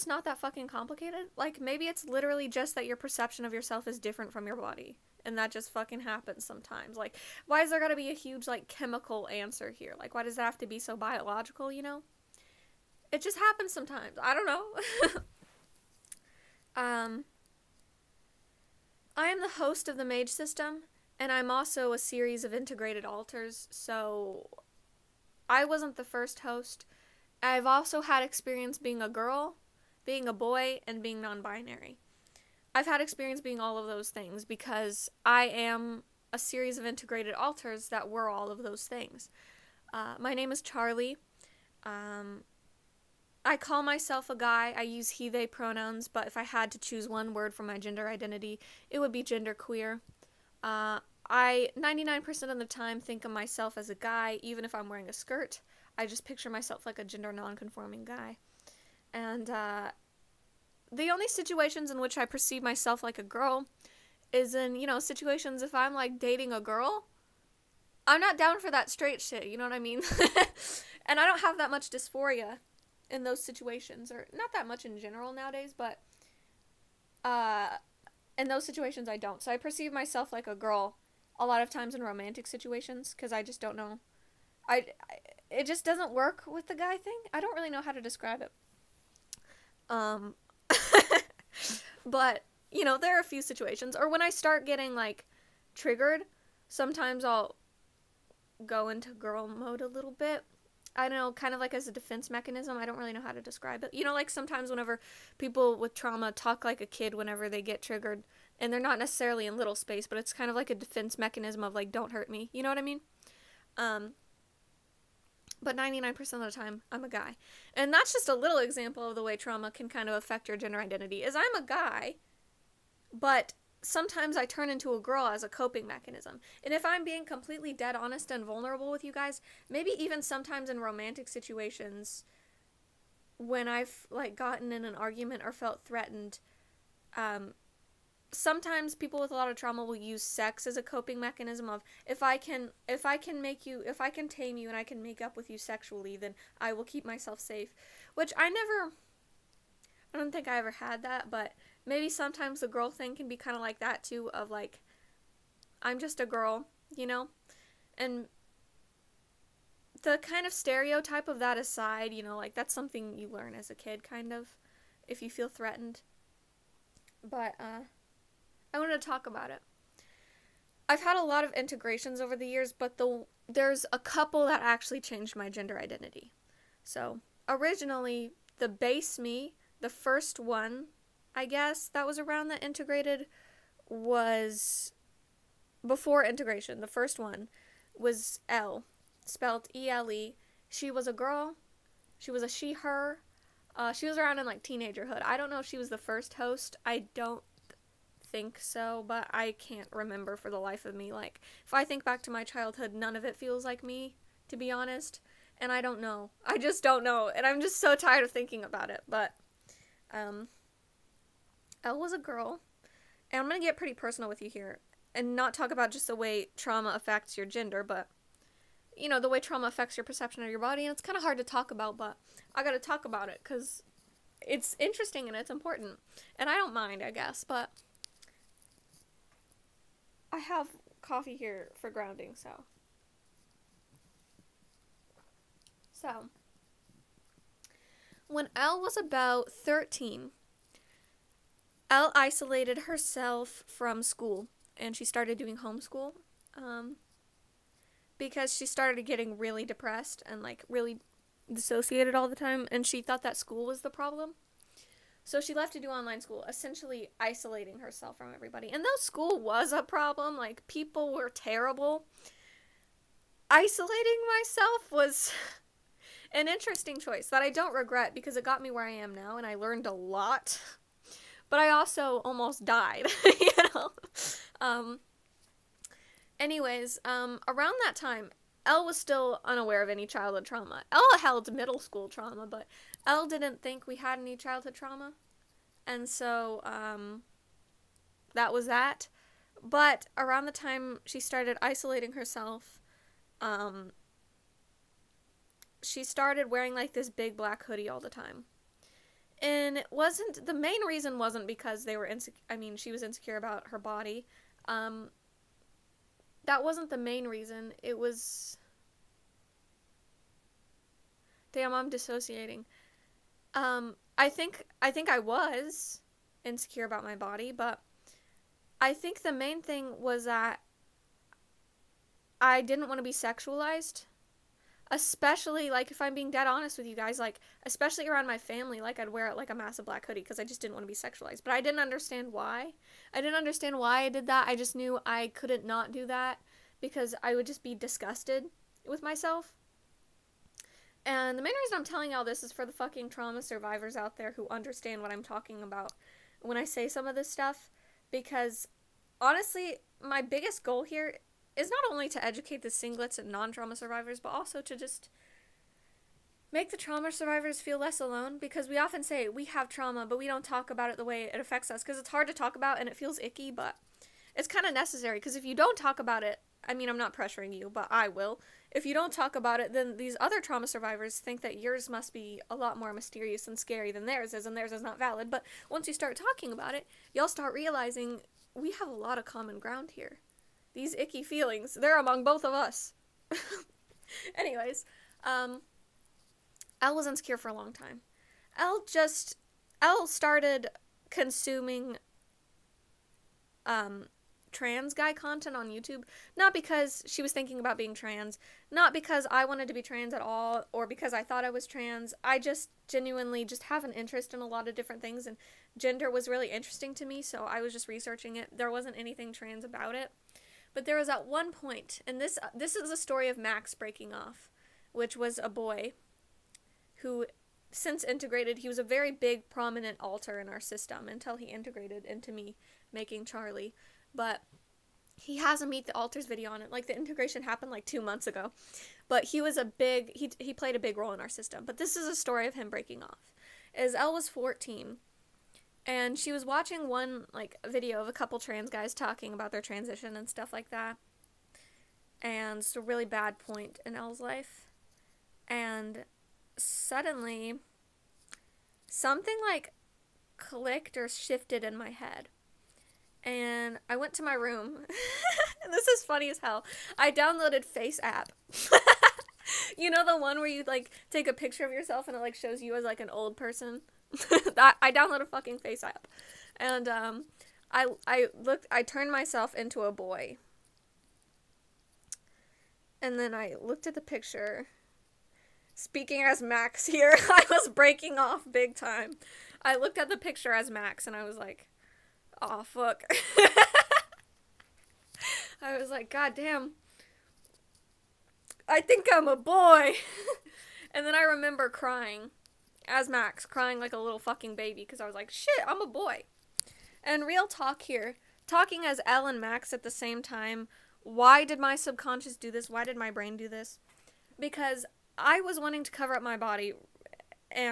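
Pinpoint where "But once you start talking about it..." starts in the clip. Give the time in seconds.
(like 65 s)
375 s.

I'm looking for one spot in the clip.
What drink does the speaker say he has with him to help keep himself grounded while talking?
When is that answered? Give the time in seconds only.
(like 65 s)
231 s.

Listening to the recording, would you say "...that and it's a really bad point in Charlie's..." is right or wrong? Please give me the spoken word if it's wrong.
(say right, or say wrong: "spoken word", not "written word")
wrong: "Elle", not "Charlie".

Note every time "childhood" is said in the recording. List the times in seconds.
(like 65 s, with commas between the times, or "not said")
202 s, 280 s, 284 s.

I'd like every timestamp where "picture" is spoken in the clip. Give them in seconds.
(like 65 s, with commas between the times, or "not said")
56 s, 461 s, 474 s, 480 s.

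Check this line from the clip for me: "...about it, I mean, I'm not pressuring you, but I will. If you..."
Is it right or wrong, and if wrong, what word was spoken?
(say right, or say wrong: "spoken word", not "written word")
right.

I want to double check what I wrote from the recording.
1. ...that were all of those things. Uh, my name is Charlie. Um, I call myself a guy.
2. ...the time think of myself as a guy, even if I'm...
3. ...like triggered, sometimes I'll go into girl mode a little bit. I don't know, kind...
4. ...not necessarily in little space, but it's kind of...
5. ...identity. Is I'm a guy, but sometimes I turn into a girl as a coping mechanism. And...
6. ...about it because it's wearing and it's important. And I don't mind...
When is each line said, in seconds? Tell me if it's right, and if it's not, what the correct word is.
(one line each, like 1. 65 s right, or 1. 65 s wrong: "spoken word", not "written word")
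1. 37 s right
2. 52 s right
3. 94 s right
4. 108 s right
5. 120 s right
6. 223 s wrong: "interesting", not "wearing".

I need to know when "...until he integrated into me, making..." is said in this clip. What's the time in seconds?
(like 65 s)
421 s.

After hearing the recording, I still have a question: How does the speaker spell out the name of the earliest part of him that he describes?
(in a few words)
E L E.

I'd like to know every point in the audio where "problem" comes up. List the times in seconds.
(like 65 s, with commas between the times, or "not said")
253 s, 259 s.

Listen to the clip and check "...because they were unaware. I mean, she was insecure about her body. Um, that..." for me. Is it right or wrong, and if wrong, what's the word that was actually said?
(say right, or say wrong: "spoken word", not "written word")
wrong: "insecure", not "unaware".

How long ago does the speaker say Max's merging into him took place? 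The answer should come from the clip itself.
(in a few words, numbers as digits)
2 months ago.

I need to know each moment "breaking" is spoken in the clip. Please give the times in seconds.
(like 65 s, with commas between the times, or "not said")
413 s, 432 s, 477 s.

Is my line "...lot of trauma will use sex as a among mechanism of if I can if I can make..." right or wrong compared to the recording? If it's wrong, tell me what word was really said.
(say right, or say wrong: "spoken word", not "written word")
wrong: "coping", not "among".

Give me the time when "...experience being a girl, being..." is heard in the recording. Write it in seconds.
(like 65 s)
28 s.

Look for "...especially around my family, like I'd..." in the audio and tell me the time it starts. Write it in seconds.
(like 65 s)
327 s.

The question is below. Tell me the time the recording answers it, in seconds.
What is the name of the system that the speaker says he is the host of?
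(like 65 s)
20 s.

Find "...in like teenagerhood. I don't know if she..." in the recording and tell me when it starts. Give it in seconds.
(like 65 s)
194 s.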